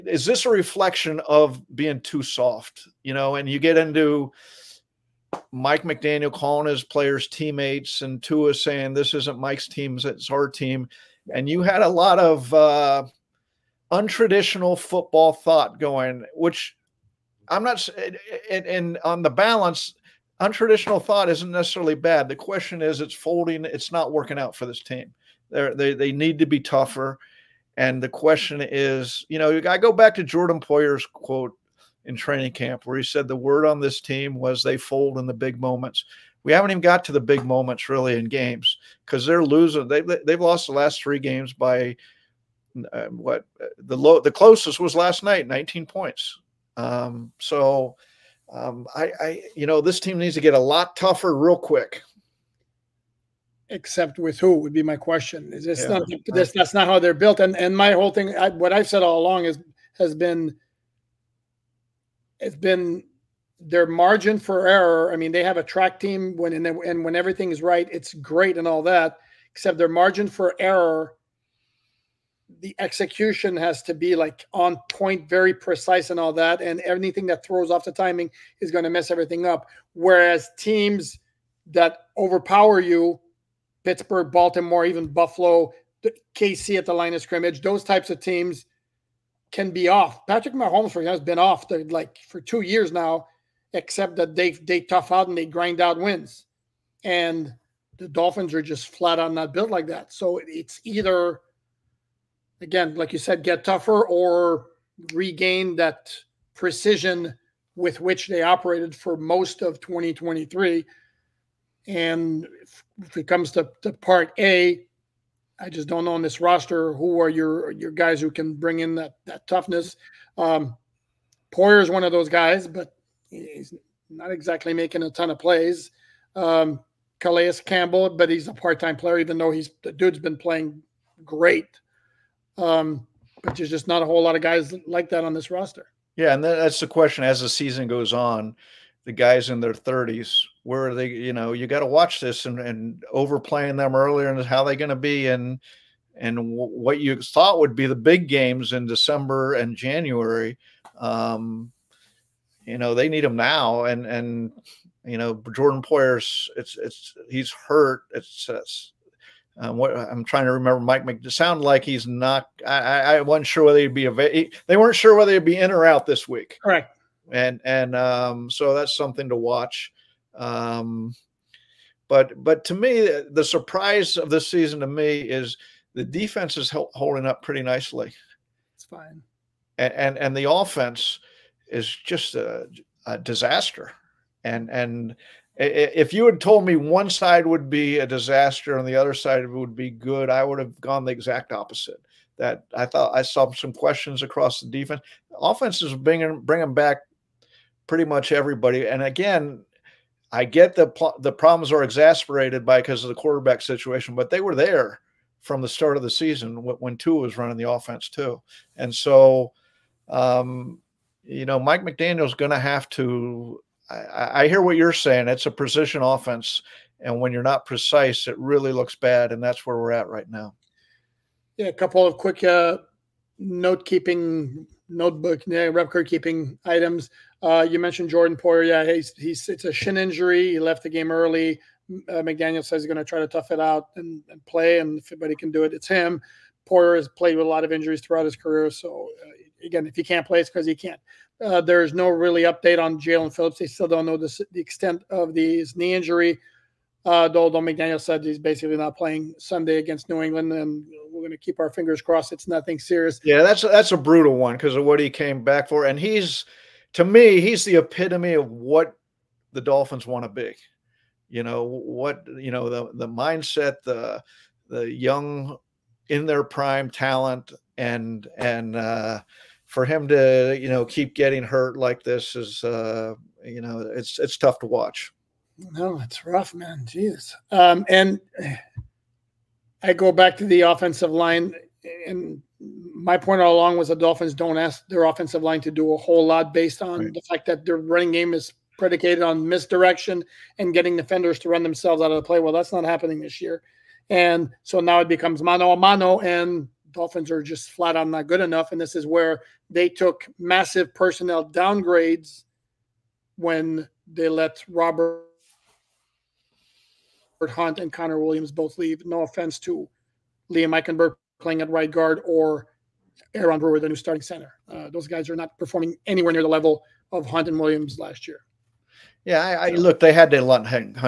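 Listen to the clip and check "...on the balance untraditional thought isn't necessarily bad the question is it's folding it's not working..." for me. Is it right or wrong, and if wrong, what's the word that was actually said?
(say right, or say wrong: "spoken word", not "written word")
right.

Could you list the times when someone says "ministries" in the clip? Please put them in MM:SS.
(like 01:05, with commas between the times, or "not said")
not said.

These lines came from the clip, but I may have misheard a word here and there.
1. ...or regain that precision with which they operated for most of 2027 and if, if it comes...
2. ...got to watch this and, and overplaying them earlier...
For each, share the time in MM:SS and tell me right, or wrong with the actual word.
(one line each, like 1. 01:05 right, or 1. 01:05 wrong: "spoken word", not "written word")
1. 01:44 wrong: "2023", not "2027"
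2. 02:21 right.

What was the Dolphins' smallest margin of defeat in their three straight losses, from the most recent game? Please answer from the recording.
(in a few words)
19 points.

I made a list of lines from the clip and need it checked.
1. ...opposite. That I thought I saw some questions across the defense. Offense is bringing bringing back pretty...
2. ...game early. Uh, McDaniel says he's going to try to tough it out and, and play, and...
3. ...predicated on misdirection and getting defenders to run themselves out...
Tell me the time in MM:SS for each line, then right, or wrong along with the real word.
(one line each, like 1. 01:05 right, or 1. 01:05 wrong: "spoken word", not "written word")
1. 03:11 right
2. 03:50 right
3. 04:48 right.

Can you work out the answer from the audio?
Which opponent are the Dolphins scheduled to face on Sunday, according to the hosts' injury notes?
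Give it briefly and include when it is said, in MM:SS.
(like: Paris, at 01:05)
New England, at 04:10.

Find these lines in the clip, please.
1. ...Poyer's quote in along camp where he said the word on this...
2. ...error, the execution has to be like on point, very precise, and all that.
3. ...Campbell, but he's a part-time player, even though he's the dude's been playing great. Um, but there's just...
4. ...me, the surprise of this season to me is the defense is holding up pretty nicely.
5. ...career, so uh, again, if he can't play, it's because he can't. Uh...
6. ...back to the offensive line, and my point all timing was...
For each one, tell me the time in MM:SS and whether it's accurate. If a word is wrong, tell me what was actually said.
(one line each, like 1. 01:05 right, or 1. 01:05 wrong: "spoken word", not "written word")
1. 00:30 wrong: "training", not "along"
2. 01:10 right
3. 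02:07 right
4. 02:52 right
5. 03:58 right
6. 04:40 wrong: "along", not "timing".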